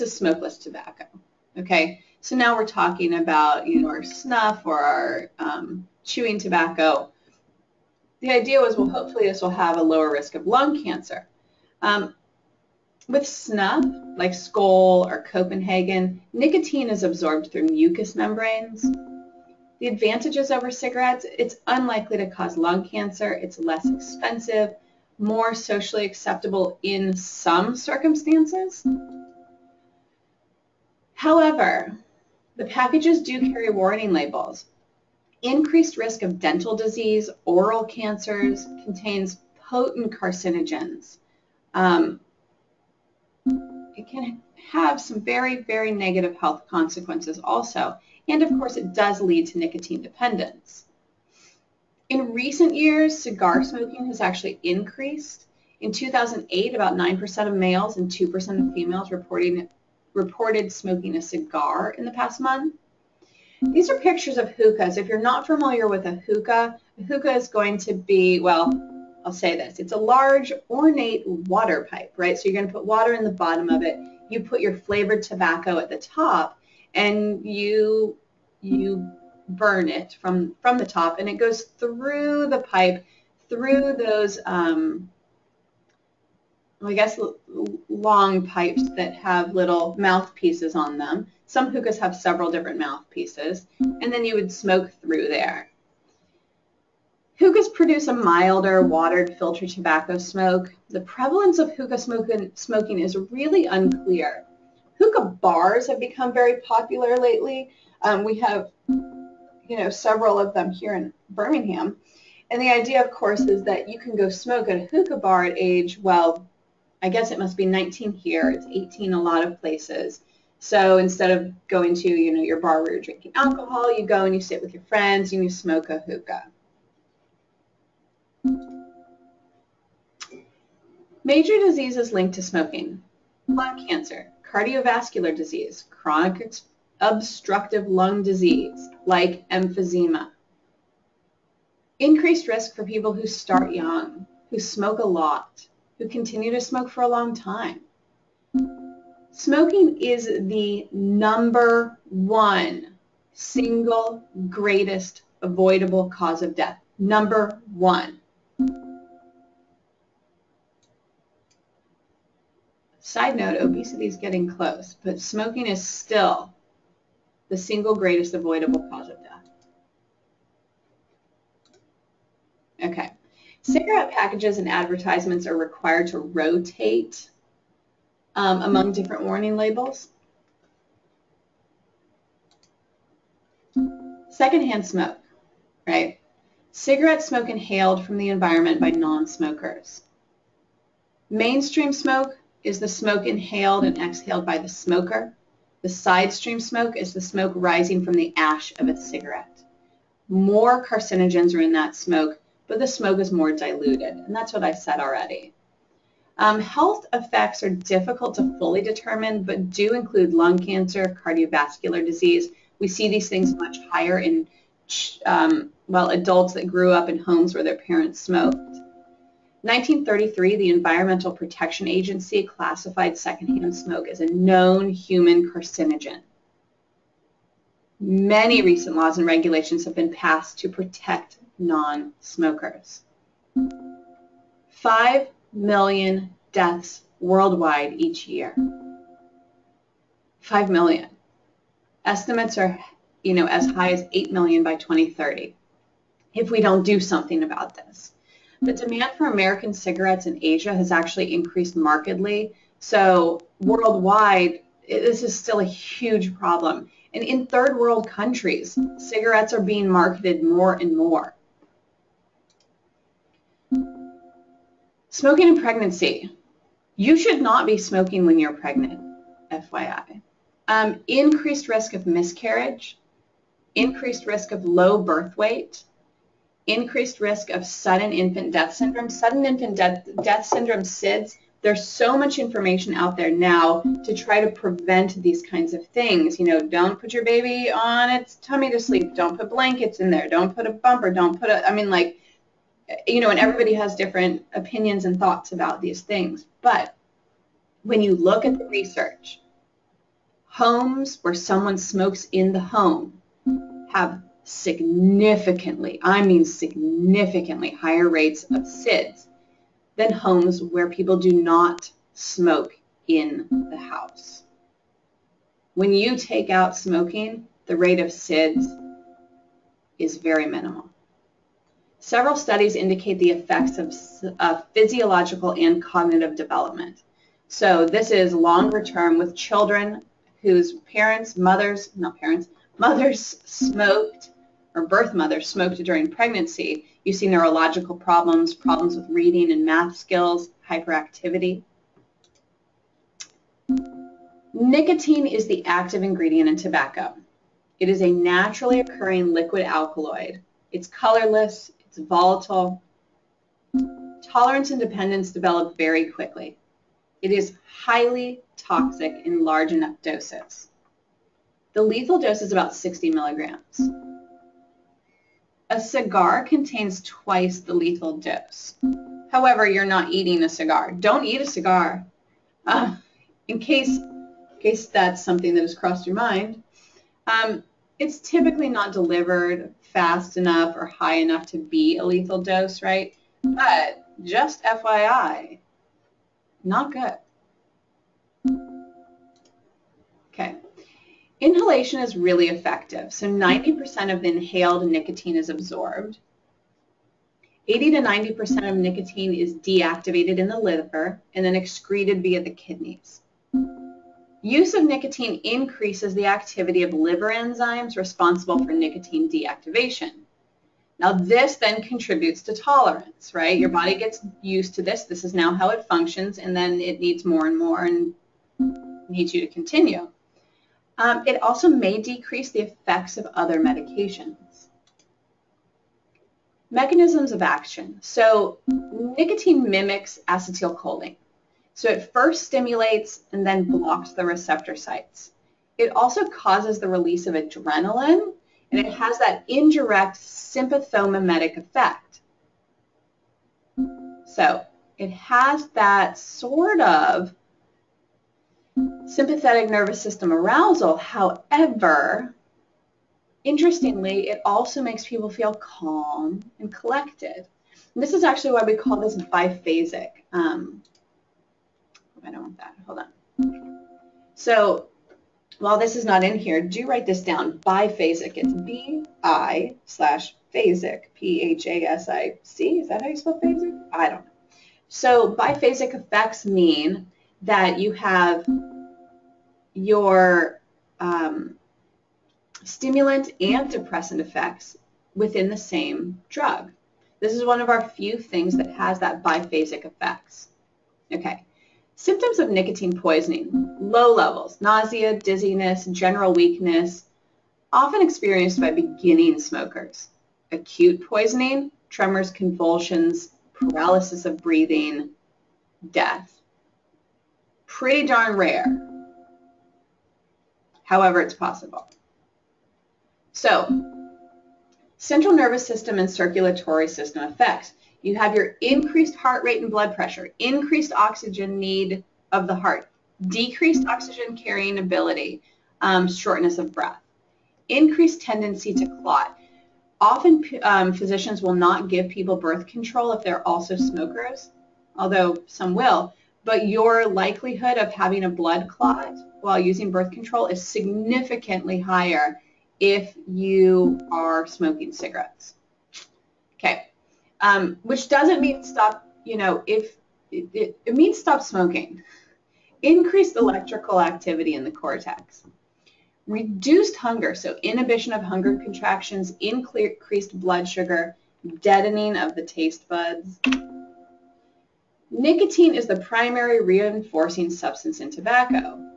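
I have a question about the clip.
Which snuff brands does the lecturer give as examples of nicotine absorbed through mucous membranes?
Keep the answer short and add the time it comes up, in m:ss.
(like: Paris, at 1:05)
Skoal or Copenhagen, at 0:14.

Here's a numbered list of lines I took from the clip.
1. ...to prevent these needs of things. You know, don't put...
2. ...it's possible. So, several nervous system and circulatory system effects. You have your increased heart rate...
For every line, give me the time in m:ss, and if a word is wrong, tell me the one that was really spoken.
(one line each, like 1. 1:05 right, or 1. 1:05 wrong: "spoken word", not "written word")
1. 4:44 wrong: "kinds", not "needs"
2. 8:31 wrong: "central", not "several".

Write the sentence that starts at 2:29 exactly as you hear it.
Smoking is the number one single greatest avoidable cause of death.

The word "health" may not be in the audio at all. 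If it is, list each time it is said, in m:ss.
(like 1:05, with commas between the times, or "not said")
0:46, 3:26.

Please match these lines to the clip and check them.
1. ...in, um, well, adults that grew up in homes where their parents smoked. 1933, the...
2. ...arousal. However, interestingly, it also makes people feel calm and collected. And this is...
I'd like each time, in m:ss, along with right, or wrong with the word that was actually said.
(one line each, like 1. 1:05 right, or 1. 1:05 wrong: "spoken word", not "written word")
1. 3:34 right
2. 7:30 right.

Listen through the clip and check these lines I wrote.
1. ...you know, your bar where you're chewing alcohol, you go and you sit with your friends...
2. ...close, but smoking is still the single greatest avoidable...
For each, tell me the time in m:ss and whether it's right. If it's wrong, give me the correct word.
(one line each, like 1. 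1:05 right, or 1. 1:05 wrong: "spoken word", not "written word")
1. 2:02 wrong: "drinking", not "chewing"
2. 2:44 right.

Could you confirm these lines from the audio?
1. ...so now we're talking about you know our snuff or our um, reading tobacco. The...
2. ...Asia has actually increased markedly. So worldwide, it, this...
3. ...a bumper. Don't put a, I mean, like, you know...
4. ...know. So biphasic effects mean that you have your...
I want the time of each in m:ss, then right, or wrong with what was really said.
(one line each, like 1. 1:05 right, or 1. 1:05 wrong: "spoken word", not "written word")
1. 0:02 wrong: "chewing", not "reading"
2. 4:10 right
3. 4:50 right
4. 7:54 right.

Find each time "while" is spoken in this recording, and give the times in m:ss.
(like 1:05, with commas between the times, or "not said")
7:45, 8:59.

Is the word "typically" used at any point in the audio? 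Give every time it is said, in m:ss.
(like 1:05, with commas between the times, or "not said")
6:18.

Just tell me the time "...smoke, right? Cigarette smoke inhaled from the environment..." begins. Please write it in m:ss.
3:04.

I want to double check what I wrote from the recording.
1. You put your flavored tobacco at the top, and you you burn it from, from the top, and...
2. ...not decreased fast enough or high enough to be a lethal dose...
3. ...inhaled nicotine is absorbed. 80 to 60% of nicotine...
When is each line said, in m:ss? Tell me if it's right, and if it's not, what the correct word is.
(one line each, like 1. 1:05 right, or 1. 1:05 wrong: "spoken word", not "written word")
1. 1:14 right
2. 6:18 wrong: "delivered", not "decreased"
3. 6:34 wrong: "90", not "60".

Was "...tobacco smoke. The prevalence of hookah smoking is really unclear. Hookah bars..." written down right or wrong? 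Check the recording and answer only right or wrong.
right.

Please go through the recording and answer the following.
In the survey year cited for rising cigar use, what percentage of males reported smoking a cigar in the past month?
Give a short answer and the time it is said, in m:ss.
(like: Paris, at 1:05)
9%, at 0:56.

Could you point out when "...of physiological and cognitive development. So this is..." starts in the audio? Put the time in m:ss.
5:24.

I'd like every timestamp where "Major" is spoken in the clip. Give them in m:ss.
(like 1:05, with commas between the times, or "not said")
2:11.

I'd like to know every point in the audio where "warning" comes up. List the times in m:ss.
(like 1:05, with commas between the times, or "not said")
0:33, 2:59.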